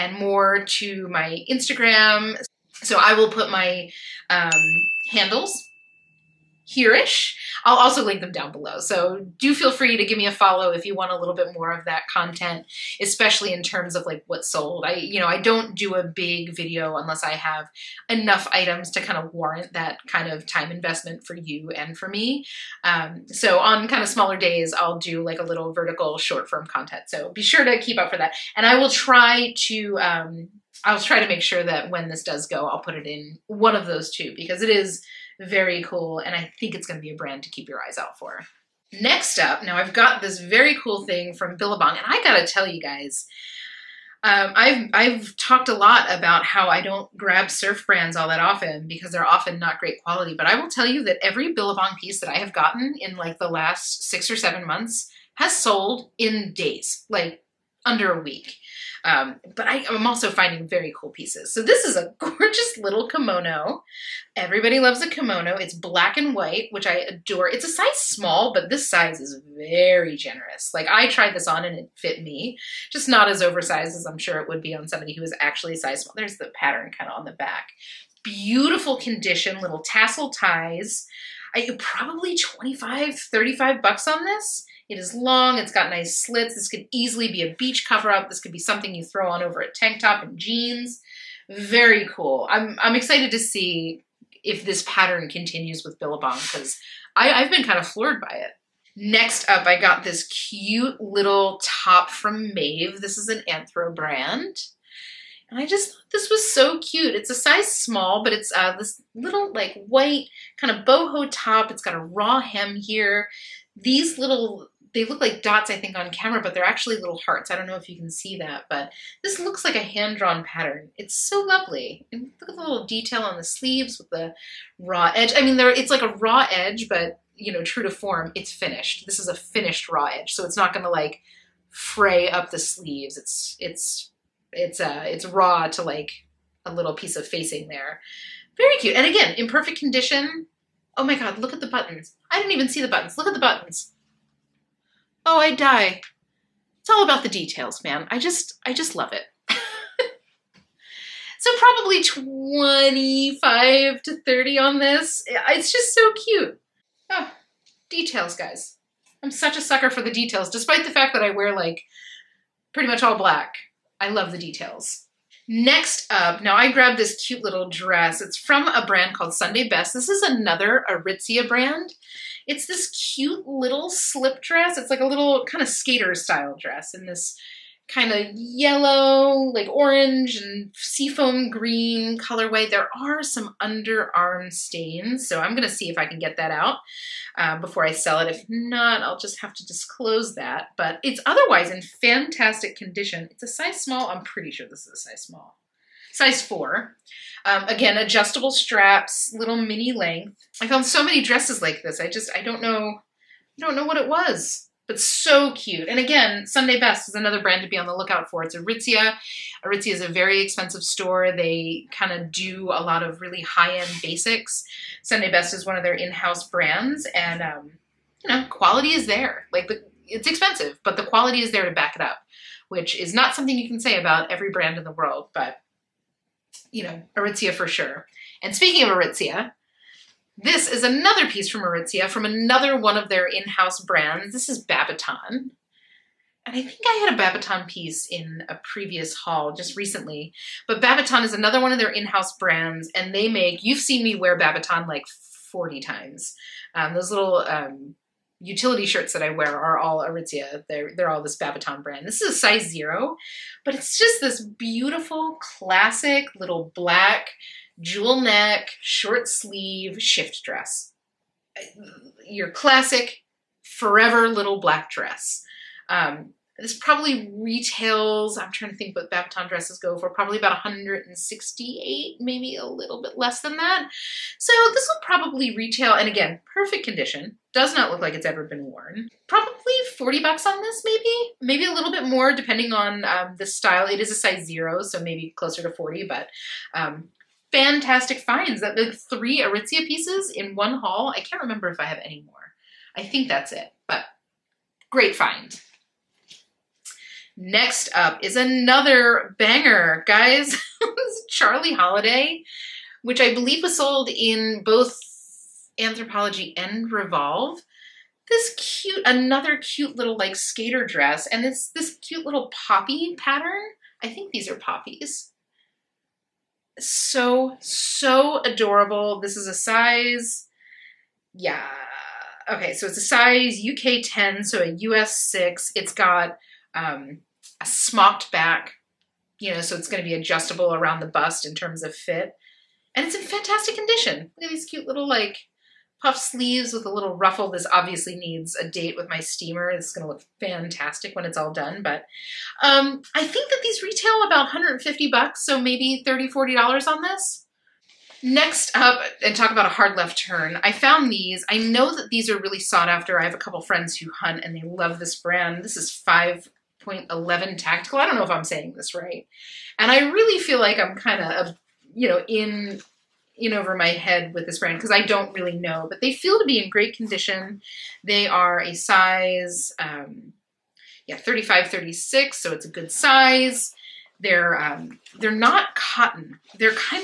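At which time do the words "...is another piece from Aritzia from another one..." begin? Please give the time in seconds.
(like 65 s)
230 s.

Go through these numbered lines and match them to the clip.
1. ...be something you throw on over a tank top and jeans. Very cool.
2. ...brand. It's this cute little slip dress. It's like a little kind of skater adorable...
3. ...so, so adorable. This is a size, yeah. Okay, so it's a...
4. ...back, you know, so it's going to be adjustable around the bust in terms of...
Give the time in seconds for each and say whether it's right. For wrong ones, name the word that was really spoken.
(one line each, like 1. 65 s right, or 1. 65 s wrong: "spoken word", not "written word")
1. 88 s right
2. 171 s wrong: "style", not "adorable"
3. 316 s right
4. 328 s right.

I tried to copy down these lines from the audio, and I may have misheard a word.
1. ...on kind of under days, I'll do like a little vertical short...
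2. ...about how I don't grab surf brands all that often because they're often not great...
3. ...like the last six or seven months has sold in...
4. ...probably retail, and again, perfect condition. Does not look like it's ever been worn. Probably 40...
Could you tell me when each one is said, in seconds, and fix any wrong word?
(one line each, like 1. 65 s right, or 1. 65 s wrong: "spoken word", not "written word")
1. 23 s wrong: "smaller", not "under"
2. 46 s right
3. 53 s right
4. 275 s right.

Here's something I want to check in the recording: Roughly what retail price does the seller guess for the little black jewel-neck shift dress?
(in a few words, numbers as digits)
168.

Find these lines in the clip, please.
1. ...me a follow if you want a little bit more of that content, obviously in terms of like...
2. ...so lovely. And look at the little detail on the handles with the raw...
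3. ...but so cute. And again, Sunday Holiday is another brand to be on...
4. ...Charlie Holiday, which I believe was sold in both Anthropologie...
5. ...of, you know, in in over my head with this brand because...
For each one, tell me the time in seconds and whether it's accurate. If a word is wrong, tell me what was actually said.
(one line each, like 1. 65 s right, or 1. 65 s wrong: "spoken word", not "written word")
1. 10 s wrong: "especially", not "obviously"
2. 121 s wrong: "sleeves", not "handles"
3. 204 s wrong: "Best", not "Holiday"
4. 301 s right
5. 361 s right.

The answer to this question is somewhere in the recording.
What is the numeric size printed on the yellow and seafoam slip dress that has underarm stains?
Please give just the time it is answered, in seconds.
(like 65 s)
196 s.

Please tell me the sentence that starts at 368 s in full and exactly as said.
They are a size, um, yeah, 35, 36, so it's a good size.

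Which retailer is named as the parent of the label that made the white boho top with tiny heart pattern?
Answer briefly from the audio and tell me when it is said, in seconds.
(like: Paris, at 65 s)
Anthro, at 103 s.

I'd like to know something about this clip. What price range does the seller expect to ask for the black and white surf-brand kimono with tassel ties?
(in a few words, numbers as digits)
$25 to $35.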